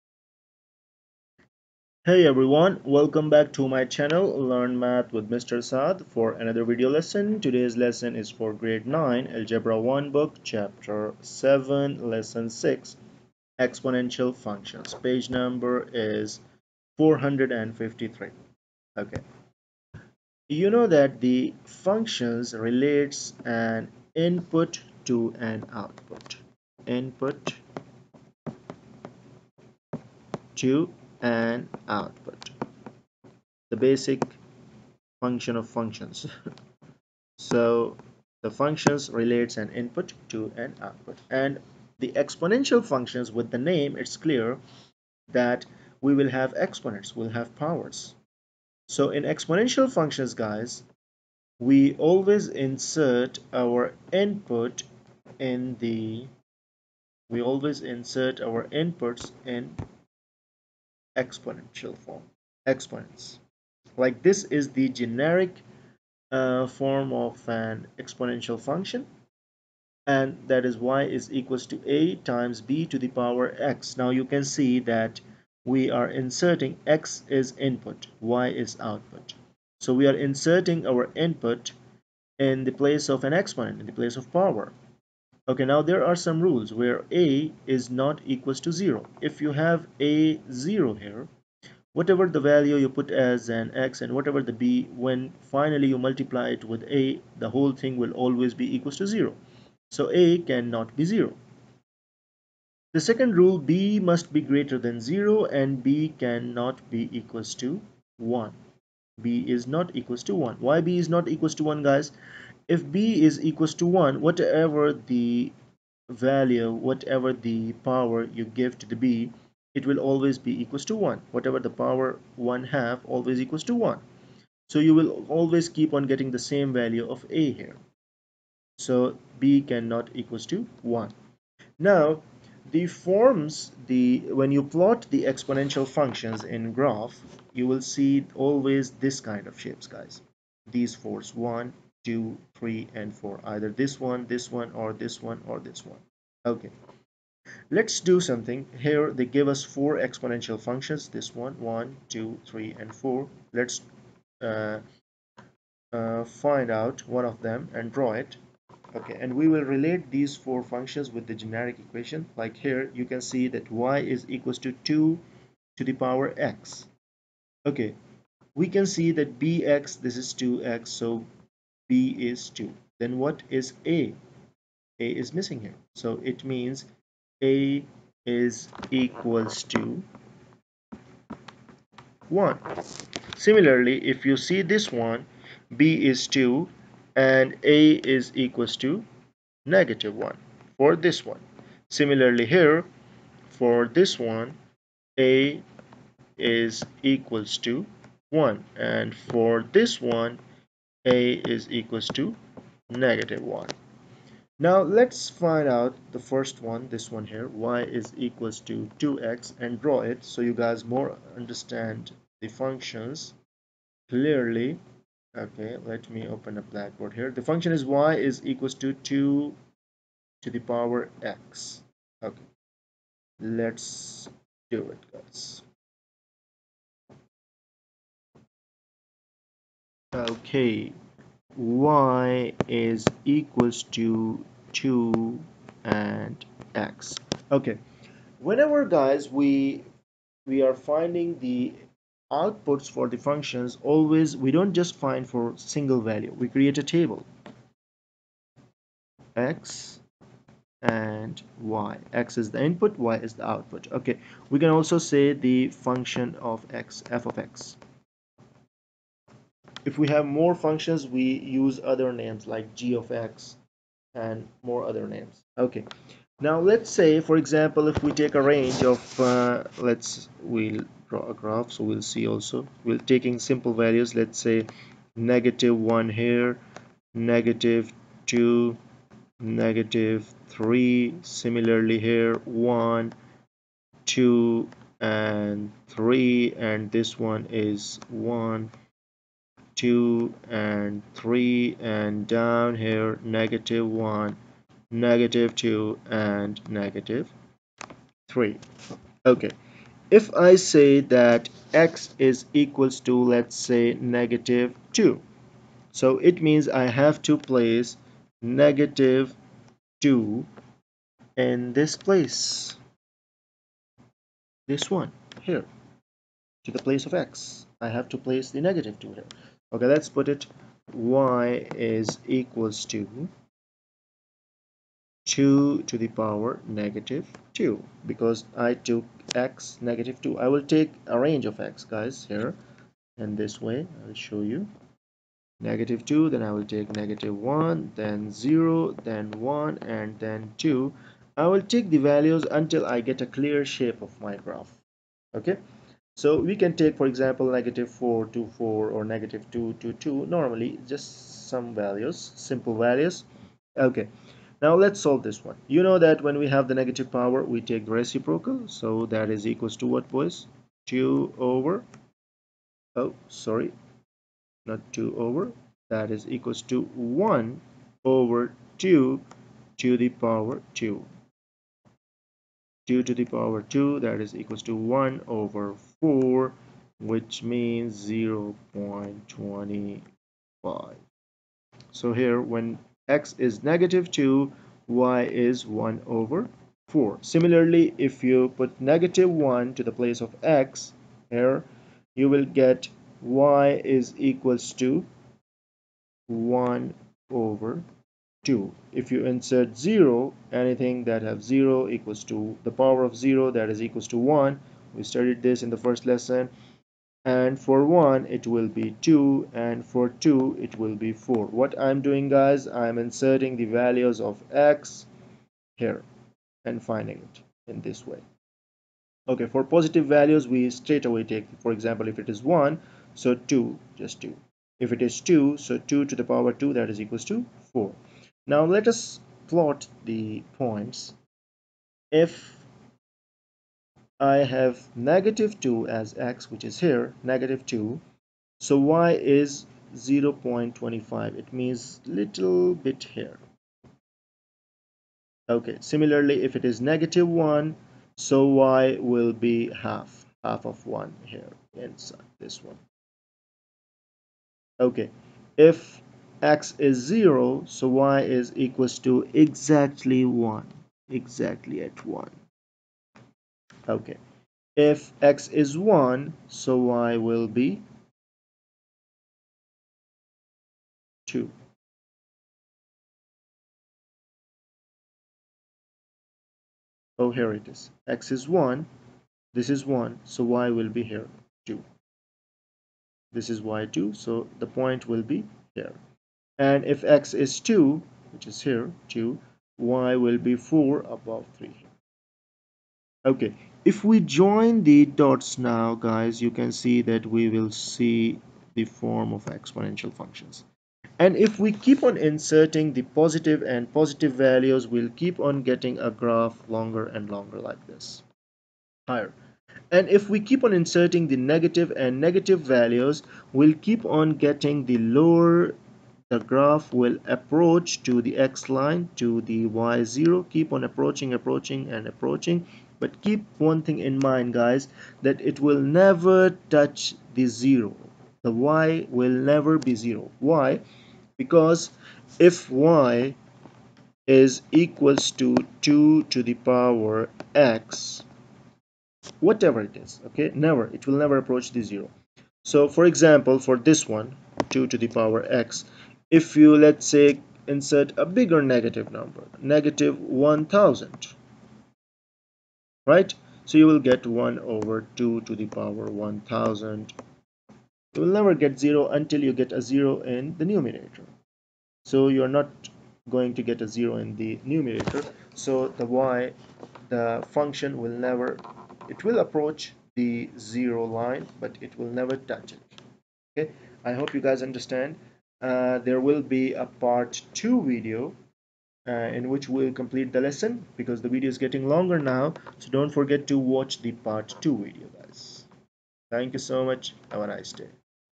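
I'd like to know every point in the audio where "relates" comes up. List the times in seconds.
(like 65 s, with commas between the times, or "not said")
22 s, 39 s, 159 s.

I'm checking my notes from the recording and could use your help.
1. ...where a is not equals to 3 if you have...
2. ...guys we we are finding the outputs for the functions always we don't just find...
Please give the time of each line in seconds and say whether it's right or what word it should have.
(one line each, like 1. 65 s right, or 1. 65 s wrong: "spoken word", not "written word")
1. 86 s wrong: "0", not "3"
2. 238 s right.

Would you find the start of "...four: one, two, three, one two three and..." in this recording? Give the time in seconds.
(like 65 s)
140 s.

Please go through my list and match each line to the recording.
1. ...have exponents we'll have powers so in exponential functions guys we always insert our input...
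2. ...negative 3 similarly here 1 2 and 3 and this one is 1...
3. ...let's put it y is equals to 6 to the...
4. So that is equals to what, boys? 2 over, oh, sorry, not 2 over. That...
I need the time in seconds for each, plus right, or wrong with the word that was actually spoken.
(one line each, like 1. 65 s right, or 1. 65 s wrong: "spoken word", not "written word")
1. 46 s right
2. 279 s right
3. 319 s wrong: "2", not "6"
4. 358 s right.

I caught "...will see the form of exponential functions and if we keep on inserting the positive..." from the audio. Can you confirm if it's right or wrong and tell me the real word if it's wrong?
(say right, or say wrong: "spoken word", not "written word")
right.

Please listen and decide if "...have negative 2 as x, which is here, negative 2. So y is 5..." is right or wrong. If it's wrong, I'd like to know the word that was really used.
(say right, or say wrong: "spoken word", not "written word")
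wrong: "0", not "5".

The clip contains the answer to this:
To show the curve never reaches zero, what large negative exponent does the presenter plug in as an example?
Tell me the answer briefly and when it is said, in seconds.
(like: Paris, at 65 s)
-1000, at 549 s.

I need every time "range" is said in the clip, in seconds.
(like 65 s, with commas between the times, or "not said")
268 s, 331 s.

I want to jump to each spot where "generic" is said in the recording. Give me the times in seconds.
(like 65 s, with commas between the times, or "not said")
64 s, 161 s.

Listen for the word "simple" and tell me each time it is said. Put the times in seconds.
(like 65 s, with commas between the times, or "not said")
273 s, 352 s.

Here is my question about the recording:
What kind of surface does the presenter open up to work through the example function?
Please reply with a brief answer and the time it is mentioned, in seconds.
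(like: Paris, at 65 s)
blackboard, at 216 s.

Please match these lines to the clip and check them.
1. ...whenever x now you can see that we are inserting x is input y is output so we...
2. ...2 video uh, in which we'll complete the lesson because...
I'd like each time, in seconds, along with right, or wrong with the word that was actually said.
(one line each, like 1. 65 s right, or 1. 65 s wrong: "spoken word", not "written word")
1. 73 s wrong: "power", not "whenever"
2. 577 s right.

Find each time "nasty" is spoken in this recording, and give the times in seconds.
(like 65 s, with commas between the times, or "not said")
not said.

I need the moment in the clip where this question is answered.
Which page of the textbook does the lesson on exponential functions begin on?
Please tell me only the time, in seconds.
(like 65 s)
16 s.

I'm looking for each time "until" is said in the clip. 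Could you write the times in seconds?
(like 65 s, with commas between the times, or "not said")
342 s, 559 s.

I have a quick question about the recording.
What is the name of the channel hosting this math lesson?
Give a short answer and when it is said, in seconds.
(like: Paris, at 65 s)
Learn Math with Mr. Saad, at 4 s.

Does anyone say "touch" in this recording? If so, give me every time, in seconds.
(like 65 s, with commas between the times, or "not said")
526 s, 572 s.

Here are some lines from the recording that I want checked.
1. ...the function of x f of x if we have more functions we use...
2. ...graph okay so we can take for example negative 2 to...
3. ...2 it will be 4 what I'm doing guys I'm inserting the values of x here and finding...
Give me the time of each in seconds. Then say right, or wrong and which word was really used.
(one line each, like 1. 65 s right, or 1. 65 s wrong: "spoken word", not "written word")
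1. 255 s right
2. 344 s wrong: "4", not "2"
3. 410 s right.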